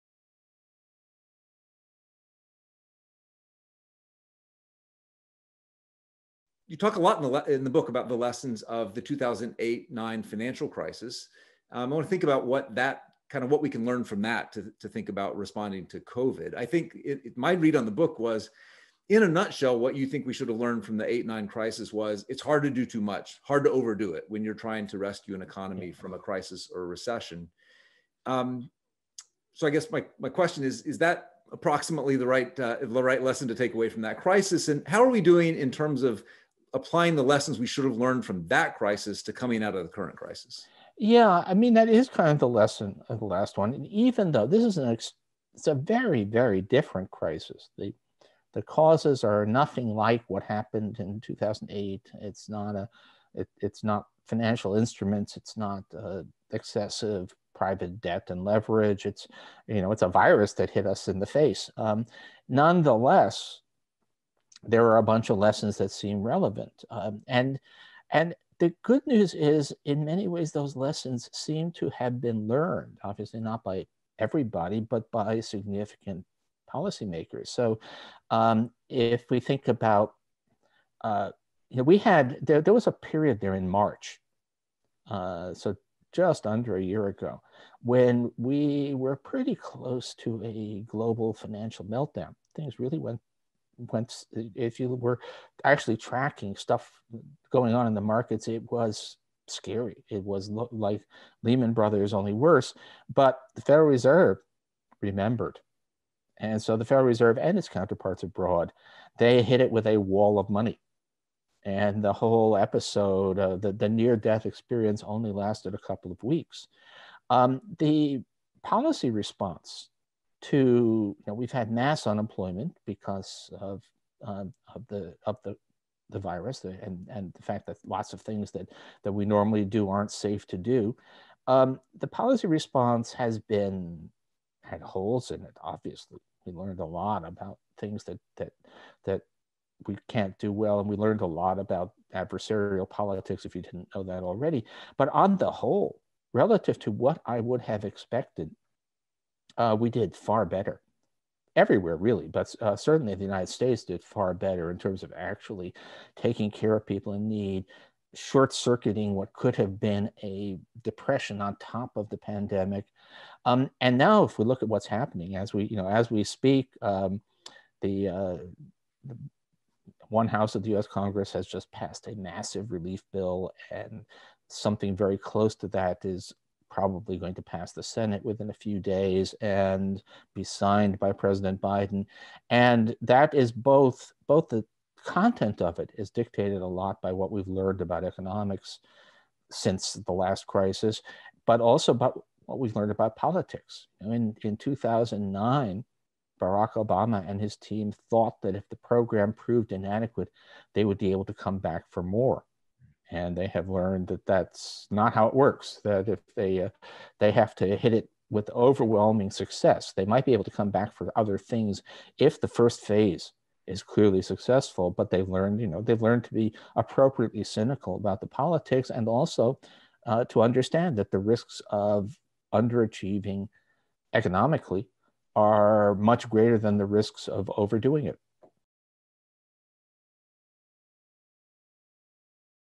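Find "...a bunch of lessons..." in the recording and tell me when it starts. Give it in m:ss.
1:04.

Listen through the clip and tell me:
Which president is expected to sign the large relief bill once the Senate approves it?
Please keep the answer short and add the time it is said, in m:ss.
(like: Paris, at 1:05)
President Biden, at 3:01.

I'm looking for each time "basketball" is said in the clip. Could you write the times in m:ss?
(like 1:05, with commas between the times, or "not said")
not said.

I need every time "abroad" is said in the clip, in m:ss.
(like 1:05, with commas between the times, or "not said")
1:48.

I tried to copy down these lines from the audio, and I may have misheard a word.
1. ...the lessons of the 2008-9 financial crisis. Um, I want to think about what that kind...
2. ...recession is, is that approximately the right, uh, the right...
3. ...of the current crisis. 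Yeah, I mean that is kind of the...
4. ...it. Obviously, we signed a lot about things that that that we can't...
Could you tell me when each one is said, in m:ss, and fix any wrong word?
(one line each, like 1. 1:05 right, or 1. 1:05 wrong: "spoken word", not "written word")
1. 0:08 right
2. 0:30 wrong: "question", not "recession"
3. 0:39 right
4. 2:15 wrong: "learned", not "signed".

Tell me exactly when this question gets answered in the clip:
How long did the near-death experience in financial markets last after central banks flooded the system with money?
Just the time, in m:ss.
1:55.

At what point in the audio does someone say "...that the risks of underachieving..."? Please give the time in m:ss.
3:40.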